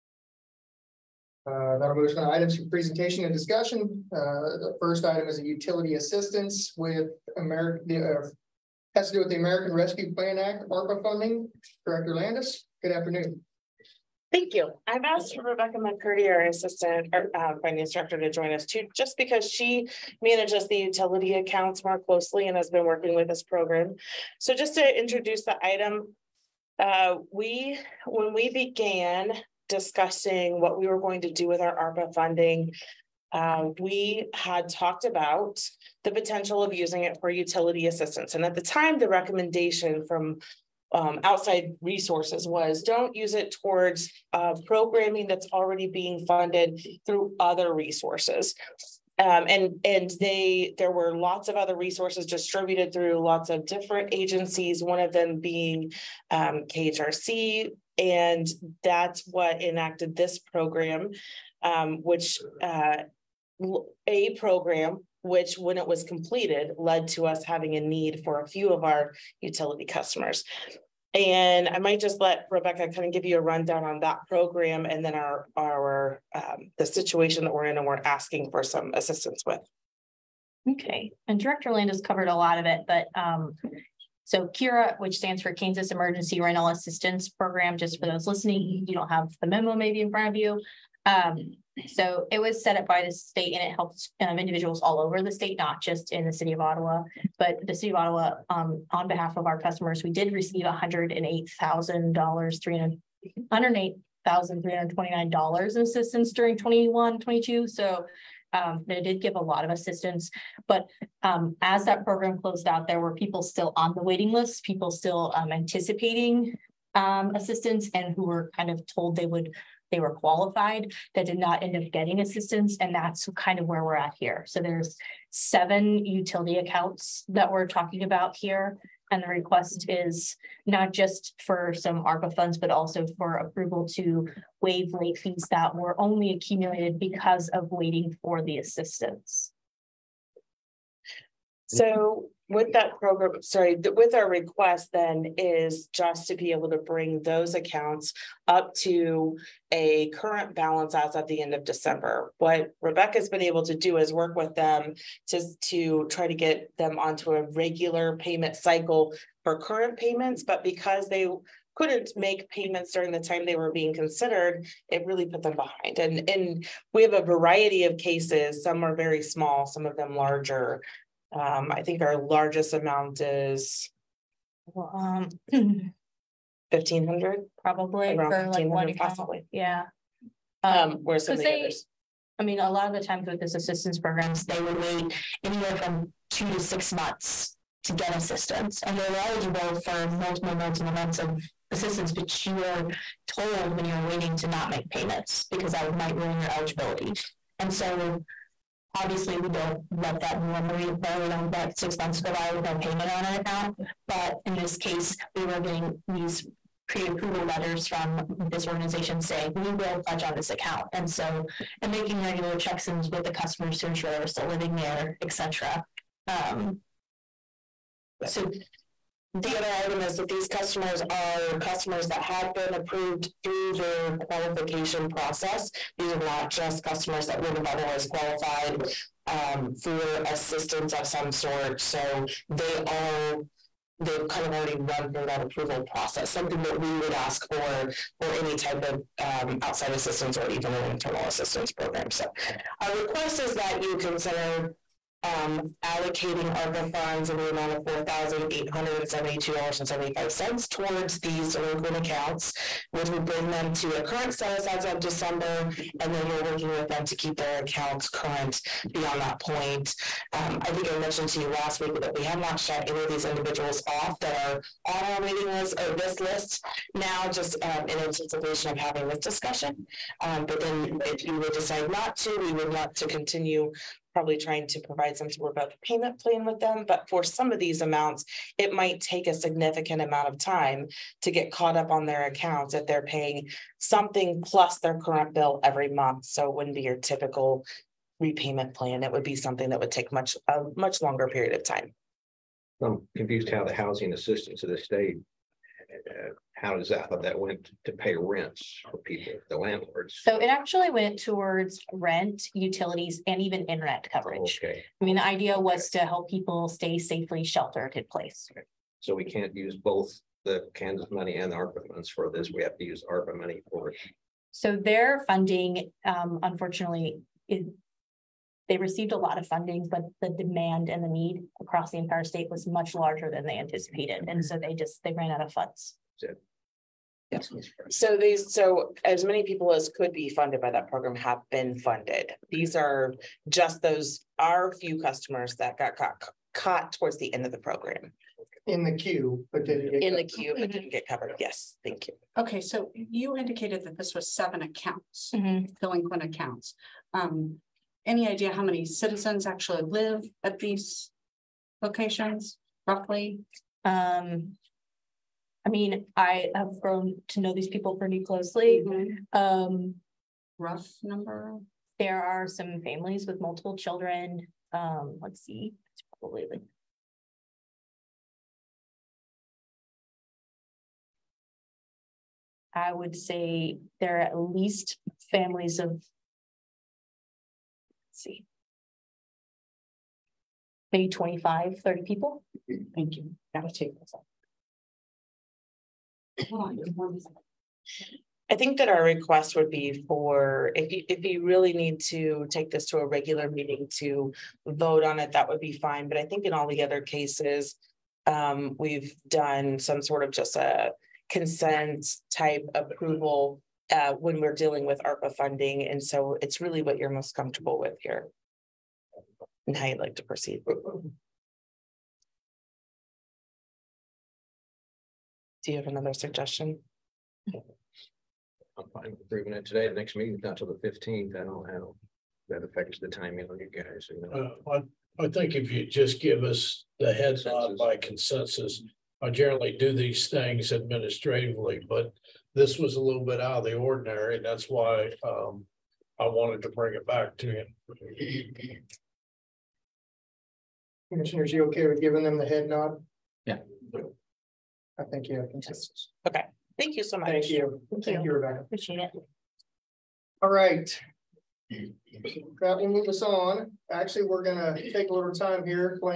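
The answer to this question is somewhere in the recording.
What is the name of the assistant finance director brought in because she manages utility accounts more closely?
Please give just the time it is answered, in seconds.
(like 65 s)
15 s.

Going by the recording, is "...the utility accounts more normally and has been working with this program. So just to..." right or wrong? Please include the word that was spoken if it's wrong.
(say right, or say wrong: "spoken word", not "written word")
wrong: "closely", not "normally".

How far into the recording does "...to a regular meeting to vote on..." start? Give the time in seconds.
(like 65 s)
392 s.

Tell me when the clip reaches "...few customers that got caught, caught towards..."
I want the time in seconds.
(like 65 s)
334 s.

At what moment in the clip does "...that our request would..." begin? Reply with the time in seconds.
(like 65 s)
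388 s.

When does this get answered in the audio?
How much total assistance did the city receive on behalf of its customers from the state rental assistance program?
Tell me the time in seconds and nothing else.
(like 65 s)
103 s.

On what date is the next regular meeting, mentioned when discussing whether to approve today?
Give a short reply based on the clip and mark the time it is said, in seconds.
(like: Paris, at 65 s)
the 15th, at 420 s.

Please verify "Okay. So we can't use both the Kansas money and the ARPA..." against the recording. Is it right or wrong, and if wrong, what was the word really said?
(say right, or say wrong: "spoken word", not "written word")
right.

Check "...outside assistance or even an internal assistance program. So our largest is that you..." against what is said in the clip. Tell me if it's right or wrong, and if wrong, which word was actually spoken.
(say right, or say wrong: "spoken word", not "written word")
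wrong: "request", not "largest".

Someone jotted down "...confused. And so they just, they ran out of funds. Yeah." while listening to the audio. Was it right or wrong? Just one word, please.
wrong.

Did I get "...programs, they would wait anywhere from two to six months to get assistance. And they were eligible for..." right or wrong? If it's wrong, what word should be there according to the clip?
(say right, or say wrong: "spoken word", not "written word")
right.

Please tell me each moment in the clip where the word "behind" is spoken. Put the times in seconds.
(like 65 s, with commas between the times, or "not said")
165 s.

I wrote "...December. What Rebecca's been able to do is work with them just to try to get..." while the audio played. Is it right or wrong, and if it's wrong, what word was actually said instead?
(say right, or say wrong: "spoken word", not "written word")
right.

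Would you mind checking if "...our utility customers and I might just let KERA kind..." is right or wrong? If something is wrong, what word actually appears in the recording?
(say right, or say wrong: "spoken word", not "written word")
wrong: "Rebecca", not "KERA".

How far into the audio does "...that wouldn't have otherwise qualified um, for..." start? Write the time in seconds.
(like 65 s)
227 s.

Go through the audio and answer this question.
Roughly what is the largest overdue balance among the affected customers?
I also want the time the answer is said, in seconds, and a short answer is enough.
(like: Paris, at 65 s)
$1,500, at 178 s.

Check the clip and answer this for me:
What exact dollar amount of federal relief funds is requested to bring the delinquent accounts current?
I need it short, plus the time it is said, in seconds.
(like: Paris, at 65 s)
$4,872.75, at 247 s.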